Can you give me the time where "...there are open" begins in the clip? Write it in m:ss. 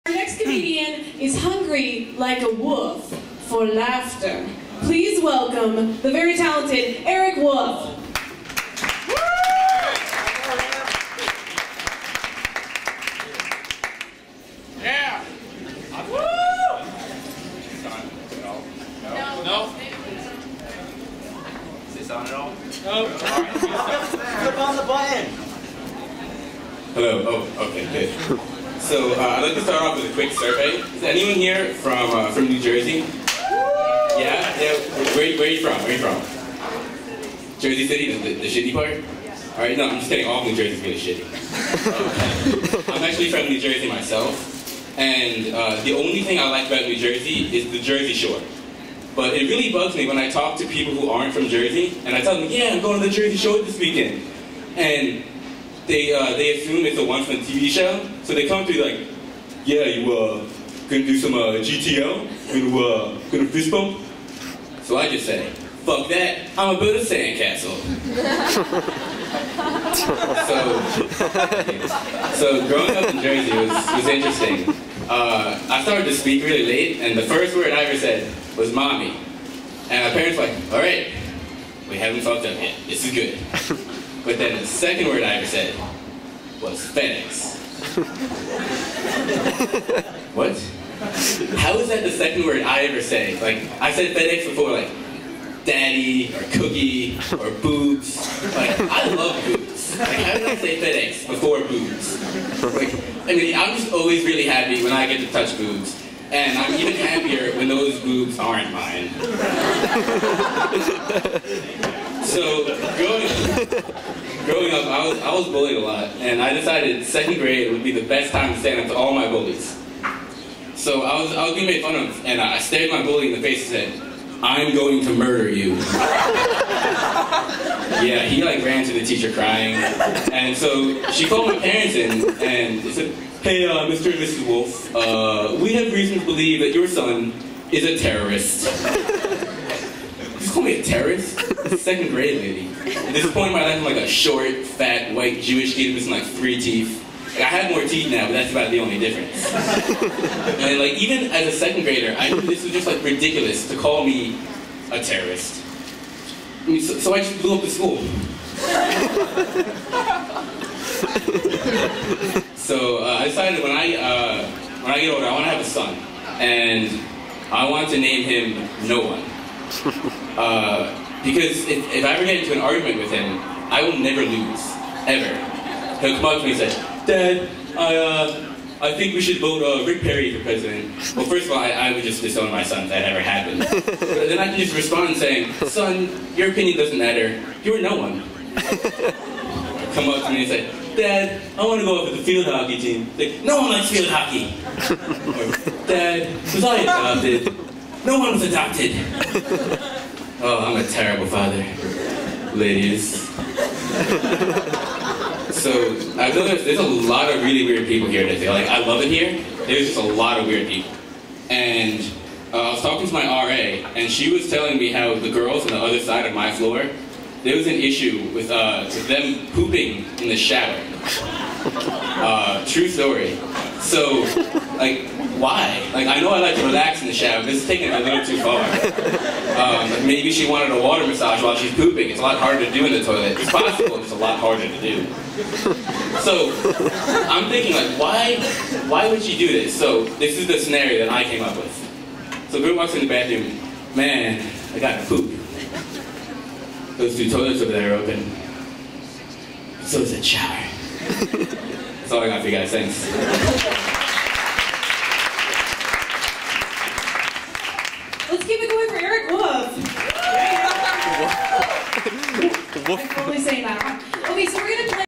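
4:07.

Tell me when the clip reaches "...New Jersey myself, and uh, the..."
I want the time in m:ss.
0:43.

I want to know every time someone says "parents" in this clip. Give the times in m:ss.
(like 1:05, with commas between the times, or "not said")
1:20, 2:11.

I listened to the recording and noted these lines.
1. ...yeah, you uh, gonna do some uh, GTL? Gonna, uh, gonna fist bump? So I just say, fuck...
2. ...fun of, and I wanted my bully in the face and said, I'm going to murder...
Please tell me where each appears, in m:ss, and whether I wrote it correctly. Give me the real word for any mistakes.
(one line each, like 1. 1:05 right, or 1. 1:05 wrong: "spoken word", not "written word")
1. 0:59 right
2. 2:01 wrong: "stared", not "wanted".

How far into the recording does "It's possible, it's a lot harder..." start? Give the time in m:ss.
3:53.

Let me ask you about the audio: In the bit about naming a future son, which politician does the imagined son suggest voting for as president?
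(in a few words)
Rick Perry.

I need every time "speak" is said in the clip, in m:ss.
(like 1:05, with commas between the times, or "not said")
1:16.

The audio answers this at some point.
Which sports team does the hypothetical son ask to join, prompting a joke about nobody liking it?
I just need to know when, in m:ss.
3:12.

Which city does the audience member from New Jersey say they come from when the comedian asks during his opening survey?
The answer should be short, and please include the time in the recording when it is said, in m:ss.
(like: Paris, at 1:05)
Jersey City, at 0:37.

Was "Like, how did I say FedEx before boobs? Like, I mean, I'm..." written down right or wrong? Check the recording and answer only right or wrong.
right.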